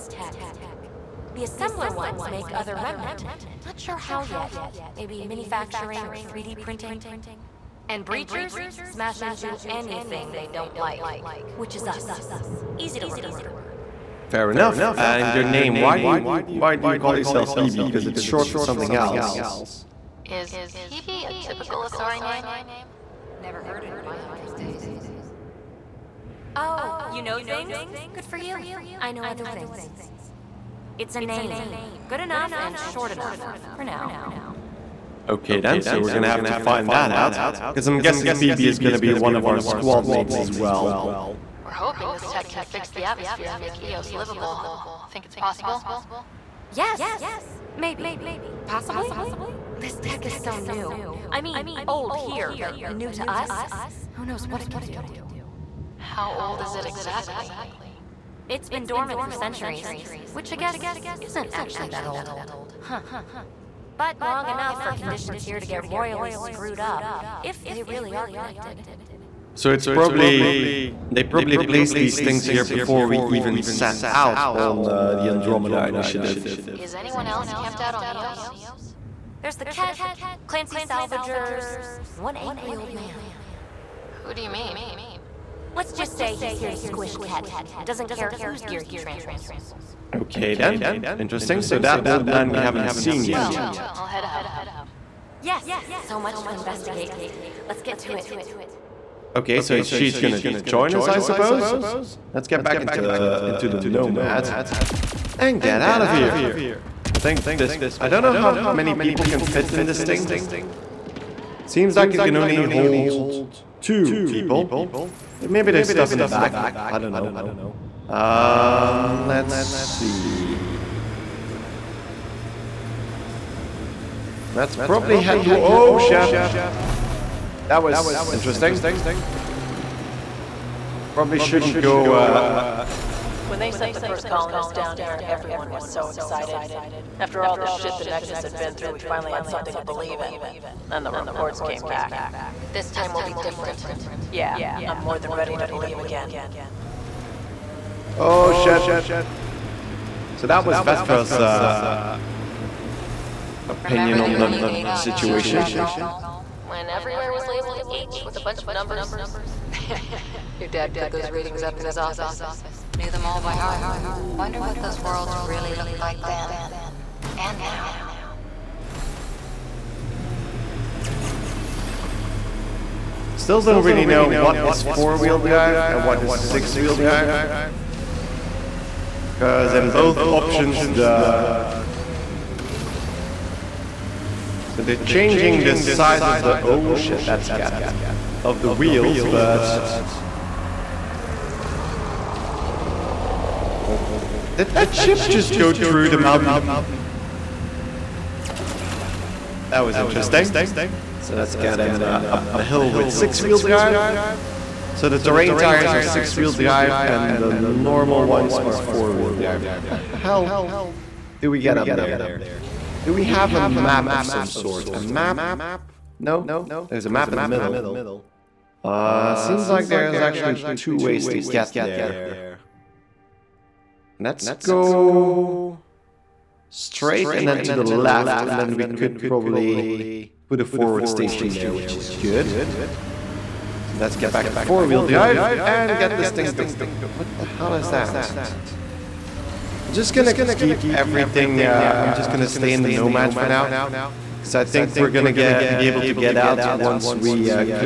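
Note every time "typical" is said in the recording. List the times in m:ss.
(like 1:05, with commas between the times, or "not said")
0:21.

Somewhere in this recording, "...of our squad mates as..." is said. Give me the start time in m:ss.
0:39.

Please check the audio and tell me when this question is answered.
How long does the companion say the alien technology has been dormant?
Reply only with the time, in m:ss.
0:59.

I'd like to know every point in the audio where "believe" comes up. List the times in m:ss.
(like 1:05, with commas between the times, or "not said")
2:19, 2:25.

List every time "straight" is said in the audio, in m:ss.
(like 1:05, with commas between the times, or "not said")
3:46.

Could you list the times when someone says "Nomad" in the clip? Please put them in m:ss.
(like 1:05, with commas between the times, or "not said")
1:43, 4:02.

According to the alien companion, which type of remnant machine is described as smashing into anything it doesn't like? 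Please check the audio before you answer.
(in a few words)
Breachers.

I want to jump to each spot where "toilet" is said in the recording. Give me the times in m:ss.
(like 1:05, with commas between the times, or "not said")
not said.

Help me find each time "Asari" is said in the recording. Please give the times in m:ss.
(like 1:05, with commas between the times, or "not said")
0:21.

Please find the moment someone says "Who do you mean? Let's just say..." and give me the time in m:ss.
1:24.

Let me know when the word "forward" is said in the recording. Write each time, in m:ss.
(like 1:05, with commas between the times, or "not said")
3:50.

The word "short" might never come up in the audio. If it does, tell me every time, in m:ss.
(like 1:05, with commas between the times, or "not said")
0:18, 0:32.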